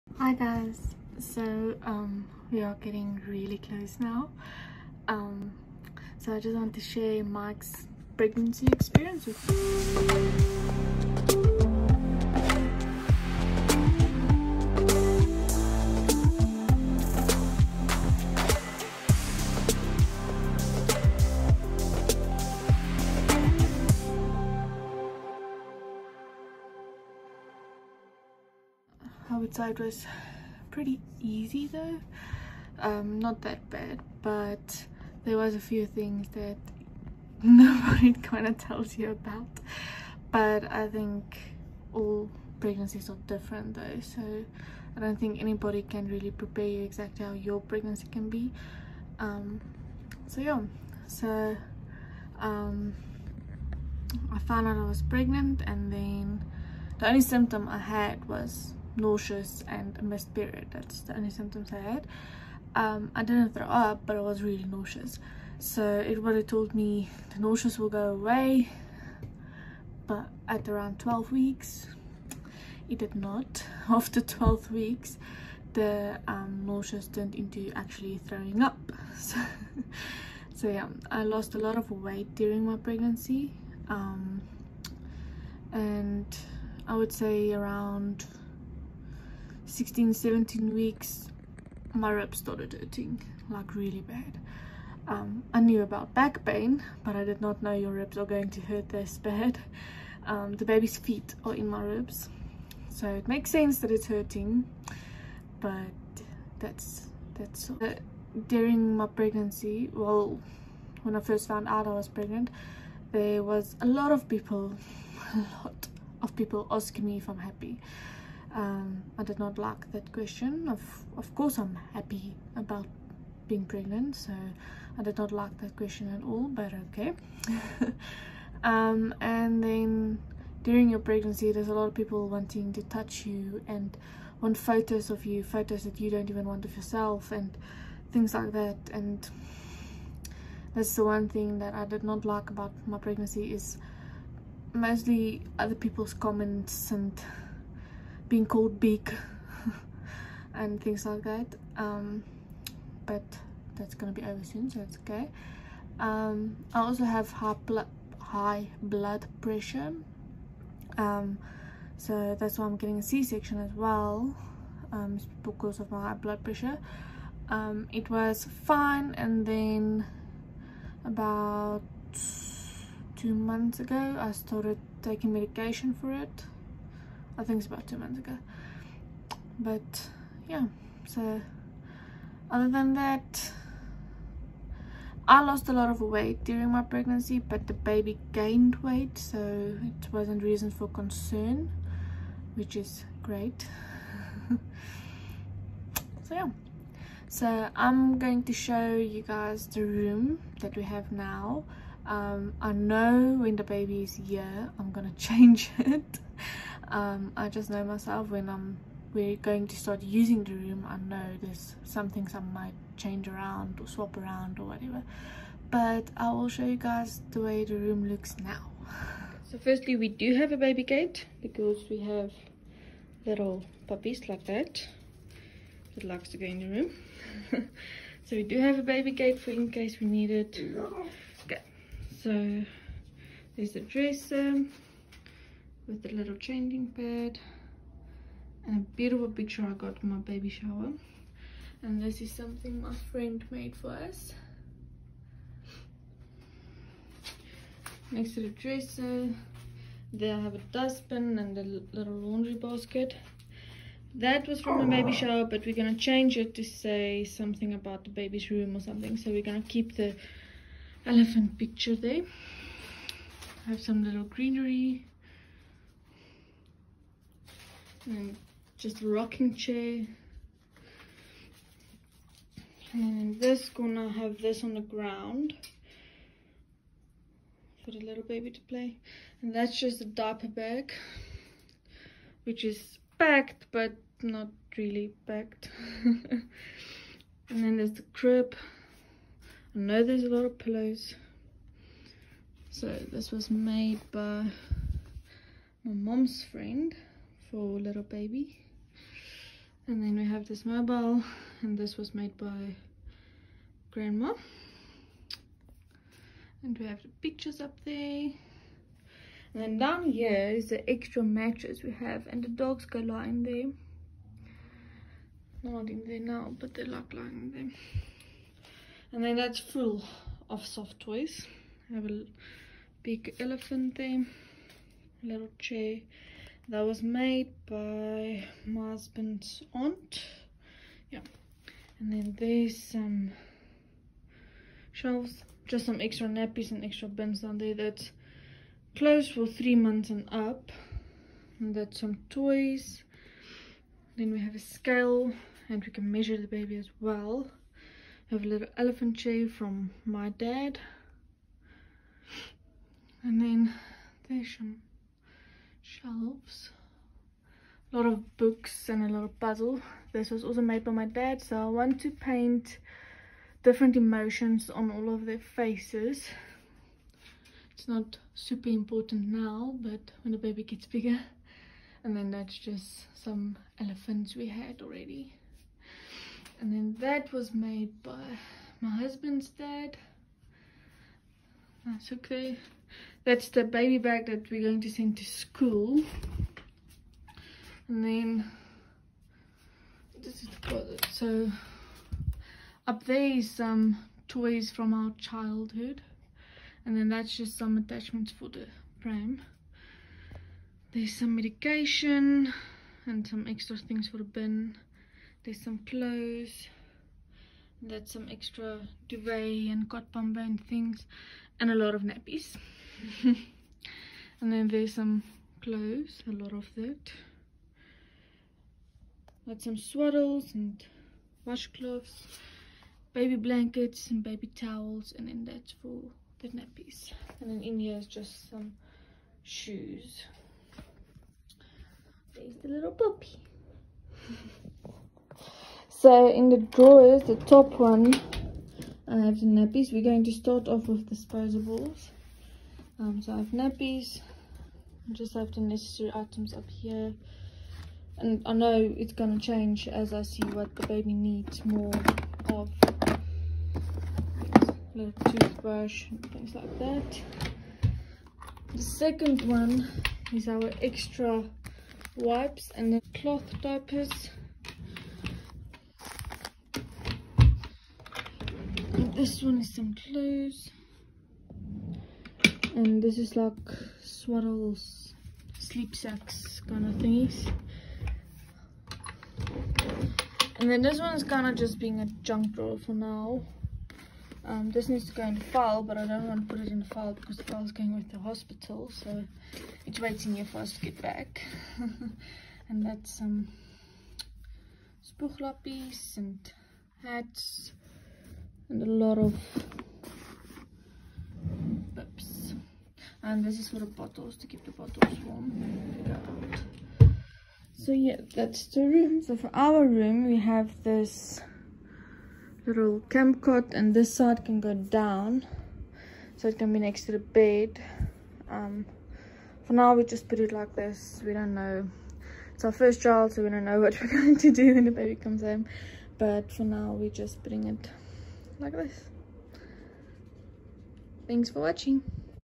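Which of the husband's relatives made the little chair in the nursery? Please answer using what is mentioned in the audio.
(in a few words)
husband's aunt.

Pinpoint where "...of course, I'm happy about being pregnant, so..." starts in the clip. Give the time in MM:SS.
02:01.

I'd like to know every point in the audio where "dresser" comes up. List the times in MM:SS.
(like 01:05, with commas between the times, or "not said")
03:53, 04:08.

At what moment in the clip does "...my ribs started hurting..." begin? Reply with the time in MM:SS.
01:31.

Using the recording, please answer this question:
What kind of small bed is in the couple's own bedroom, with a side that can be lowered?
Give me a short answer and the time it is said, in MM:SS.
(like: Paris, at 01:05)
camp cot, at 08:33.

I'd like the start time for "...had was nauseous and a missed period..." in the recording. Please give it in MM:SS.
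00:57.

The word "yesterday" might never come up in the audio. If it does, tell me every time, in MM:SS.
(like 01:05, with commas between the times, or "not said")
not said.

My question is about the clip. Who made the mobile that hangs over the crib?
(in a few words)
grandma.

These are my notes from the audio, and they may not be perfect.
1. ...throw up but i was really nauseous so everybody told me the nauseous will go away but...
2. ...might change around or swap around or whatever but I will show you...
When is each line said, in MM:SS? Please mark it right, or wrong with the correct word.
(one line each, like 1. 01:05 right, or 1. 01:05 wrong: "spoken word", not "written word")
1. 01:03 right
2. 03:32 right.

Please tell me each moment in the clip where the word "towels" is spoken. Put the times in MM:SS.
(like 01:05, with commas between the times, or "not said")
07:04.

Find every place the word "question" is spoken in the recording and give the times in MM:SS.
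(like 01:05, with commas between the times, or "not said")
02:00, 02:05.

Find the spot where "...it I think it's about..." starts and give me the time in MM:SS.
02:56.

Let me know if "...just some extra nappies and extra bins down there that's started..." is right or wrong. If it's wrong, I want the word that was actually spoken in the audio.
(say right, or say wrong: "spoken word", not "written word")
wrong: "closed", not "started".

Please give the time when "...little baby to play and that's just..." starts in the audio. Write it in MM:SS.
04:37.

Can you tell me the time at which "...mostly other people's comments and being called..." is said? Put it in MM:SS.
02:24.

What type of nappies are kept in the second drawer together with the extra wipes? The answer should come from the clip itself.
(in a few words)
cloth diapers.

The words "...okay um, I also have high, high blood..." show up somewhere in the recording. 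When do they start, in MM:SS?
02:35.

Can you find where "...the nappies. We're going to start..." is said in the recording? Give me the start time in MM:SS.
07:19.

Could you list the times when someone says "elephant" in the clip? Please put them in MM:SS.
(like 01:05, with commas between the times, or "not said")
04:21, 05:23, 05:48, 06:13.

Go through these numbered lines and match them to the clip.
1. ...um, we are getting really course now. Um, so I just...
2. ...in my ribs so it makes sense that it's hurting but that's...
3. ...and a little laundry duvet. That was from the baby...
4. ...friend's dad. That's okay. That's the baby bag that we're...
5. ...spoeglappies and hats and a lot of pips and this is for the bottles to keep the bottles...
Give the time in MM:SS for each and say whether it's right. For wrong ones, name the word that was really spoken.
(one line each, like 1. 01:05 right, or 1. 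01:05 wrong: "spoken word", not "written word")
1. 00:01 wrong: "close", not "course"
2. 01:41 right
3. 04:11 wrong: "basket", not "duvet"
4. 06:18 wrong: "husband", not "friend"
5. 08:15 right.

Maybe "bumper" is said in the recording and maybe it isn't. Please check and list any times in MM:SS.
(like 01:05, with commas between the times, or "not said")
06:50.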